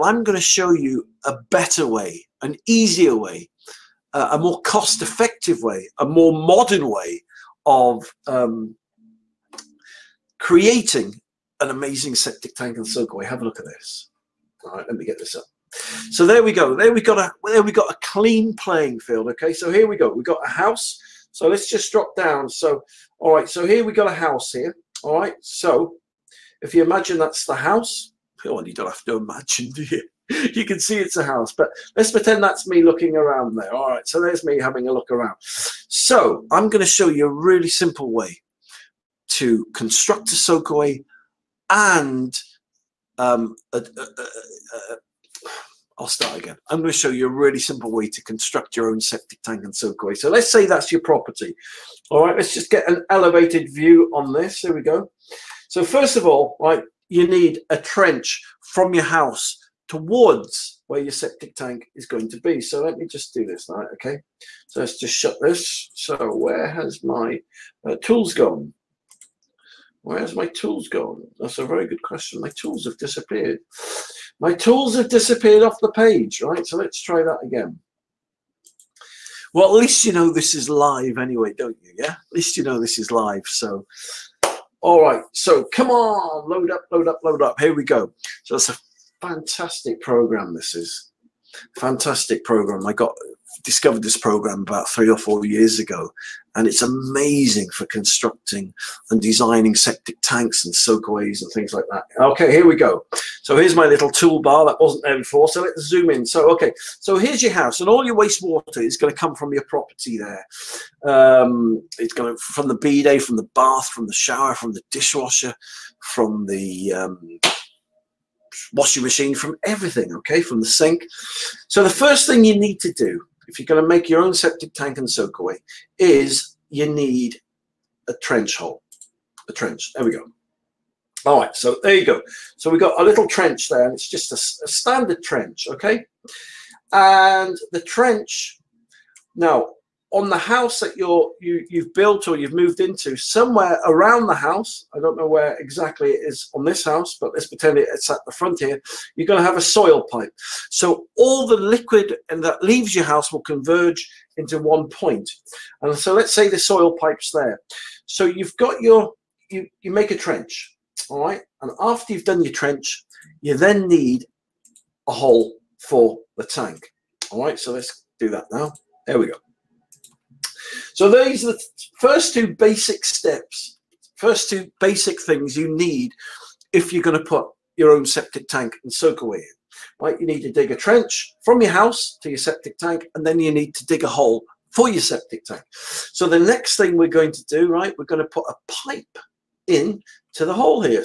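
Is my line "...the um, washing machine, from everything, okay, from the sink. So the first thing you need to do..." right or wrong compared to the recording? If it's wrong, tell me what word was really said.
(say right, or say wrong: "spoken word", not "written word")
right.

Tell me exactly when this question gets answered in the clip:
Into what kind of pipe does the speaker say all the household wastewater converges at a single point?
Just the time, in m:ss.
2:29.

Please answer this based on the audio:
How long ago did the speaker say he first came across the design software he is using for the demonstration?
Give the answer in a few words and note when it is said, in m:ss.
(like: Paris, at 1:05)
3 or 4 years ago, at 1:34.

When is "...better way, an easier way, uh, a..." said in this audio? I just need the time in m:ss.
0:01.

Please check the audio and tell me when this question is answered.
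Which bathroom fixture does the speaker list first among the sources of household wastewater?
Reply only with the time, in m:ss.
1:52.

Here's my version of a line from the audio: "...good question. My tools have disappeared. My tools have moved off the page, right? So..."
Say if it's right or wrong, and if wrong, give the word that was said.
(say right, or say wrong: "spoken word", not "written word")
wrong: "disappeared", not "moved".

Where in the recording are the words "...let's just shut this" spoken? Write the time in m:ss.
1:04.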